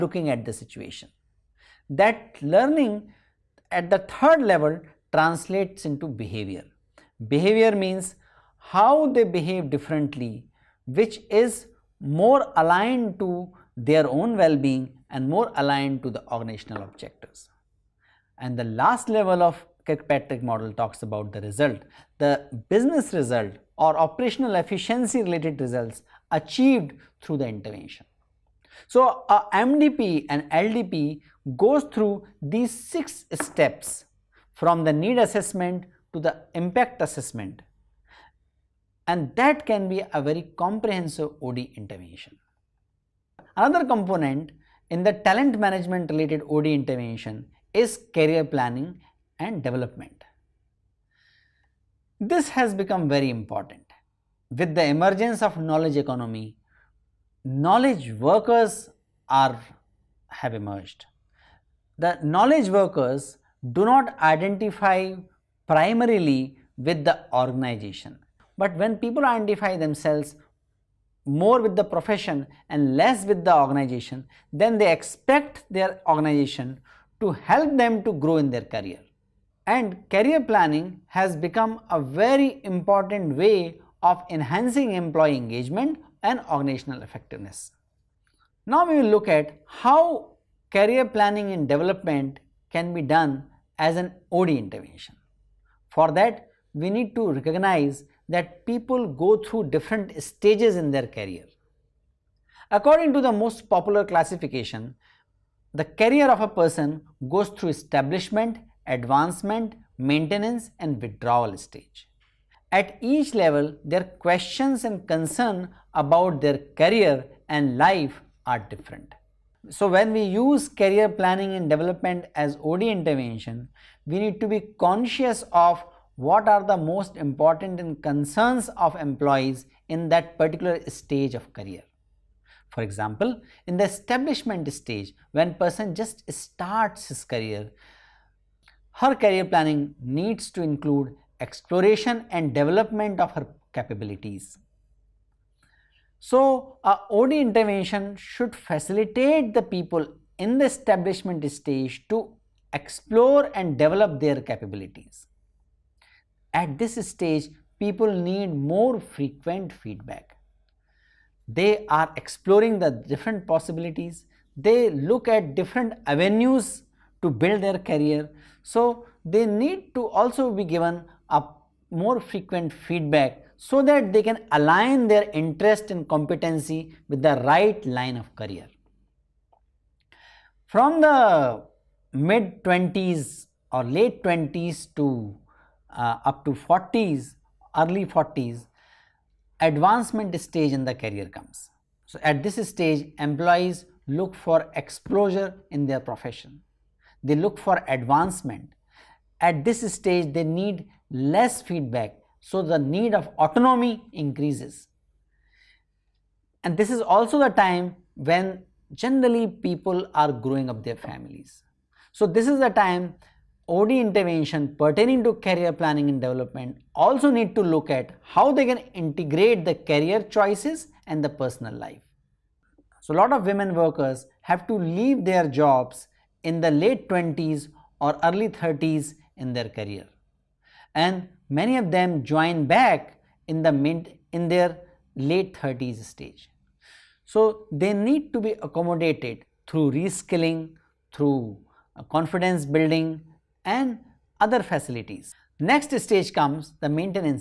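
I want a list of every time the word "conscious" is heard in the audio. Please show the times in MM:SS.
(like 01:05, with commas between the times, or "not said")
02:04.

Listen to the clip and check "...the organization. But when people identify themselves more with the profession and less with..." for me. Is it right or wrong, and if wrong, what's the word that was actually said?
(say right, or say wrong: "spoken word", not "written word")
right.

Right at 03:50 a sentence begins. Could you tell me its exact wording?
And many of them join back in the mid in their late 30s stage.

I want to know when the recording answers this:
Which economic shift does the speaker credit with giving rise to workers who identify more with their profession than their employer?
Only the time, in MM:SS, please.
00:55.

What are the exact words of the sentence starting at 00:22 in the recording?
The business result or operational efficiency related results achieved through the intervention.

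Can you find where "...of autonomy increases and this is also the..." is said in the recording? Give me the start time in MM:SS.
03:23.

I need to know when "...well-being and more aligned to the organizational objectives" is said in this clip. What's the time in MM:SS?
00:14.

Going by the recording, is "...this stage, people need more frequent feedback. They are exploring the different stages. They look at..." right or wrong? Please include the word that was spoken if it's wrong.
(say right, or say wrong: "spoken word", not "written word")
wrong: "possibilities", not "stages".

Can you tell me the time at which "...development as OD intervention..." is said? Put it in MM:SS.
02:01.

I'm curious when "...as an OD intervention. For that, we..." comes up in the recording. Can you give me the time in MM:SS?
01:33.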